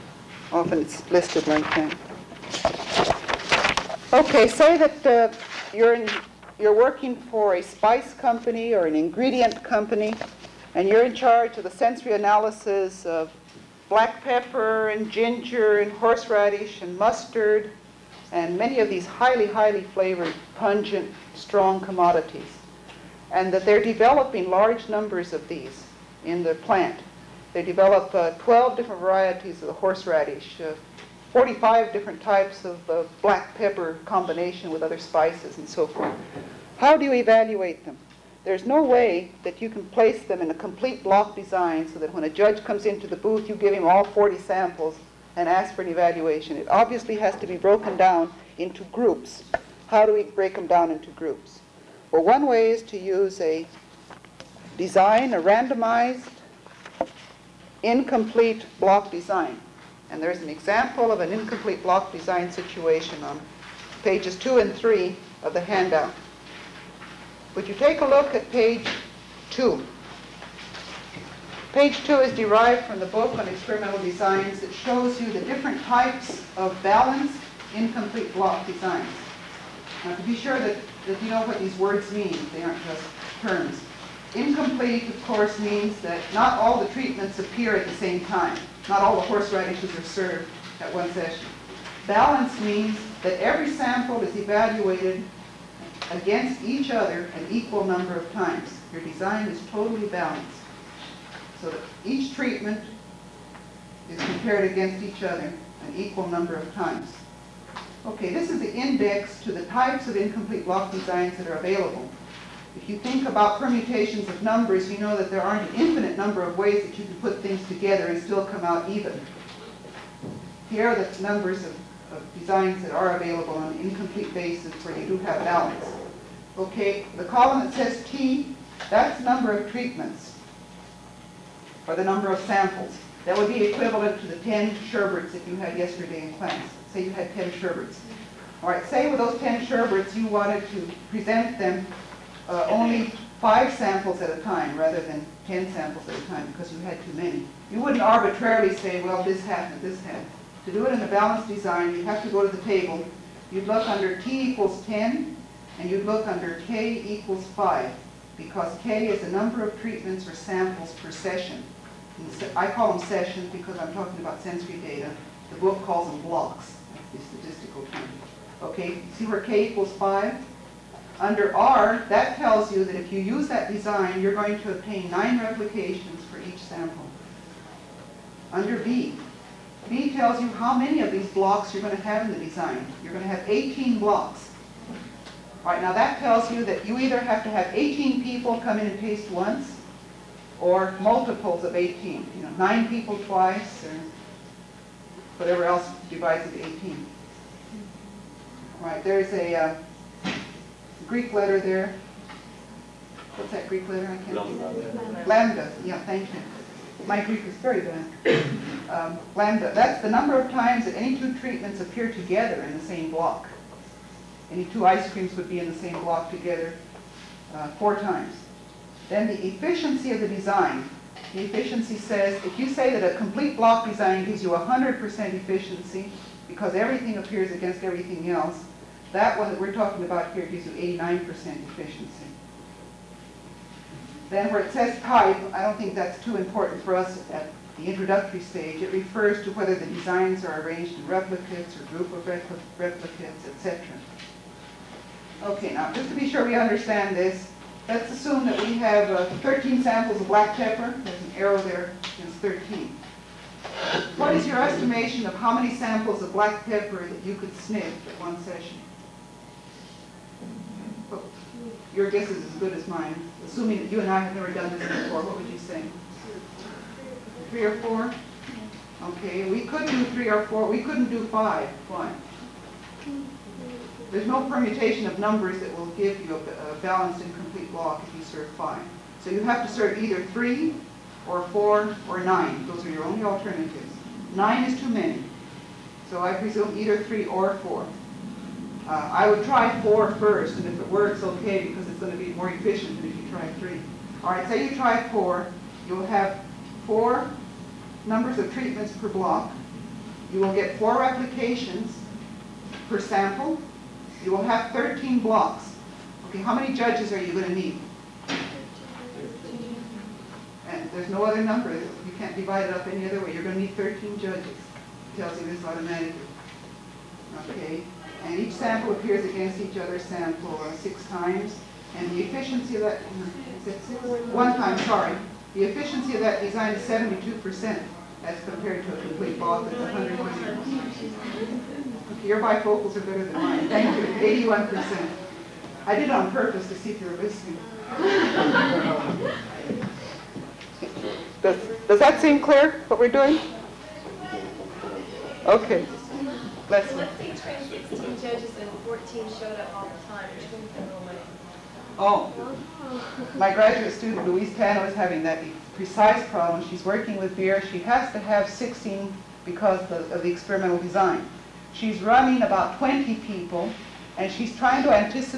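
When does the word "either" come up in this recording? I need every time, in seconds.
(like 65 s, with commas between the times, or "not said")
186 s, 280 s, 286 s.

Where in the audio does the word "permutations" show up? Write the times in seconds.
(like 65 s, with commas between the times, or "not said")
113 s, 274 s.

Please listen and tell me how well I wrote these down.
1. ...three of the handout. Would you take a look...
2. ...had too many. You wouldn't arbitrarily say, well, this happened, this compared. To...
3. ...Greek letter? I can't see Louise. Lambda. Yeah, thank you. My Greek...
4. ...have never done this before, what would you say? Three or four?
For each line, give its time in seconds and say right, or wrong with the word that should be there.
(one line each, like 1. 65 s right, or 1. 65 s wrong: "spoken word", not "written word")
1. 64 s right
2. 146 s wrong: "happened", not "compared"
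3. 203 s wrong: "Lambda", not "Louise"
4. 264 s right.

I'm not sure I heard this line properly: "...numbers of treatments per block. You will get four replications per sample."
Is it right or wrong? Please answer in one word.
right.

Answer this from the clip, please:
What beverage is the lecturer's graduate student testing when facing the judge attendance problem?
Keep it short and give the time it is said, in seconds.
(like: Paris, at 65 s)
Beer, at 357 s.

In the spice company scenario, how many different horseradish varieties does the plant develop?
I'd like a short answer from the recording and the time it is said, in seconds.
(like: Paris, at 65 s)
12, at 28 s.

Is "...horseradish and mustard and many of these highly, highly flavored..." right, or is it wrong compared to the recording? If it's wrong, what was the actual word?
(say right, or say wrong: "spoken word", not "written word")
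right.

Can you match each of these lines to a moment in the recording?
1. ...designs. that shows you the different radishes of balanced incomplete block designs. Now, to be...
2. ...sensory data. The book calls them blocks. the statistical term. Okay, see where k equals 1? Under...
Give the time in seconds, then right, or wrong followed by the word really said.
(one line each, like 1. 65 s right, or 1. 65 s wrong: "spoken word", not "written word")
1. 74 s wrong: "types", not "radishes"
2. 164 s wrong: "5", not "1".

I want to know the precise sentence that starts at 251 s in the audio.
There's an arrow there, it's 13.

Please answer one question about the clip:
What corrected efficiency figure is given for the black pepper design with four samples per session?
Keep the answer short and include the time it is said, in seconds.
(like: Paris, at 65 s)
81%, at 334 s.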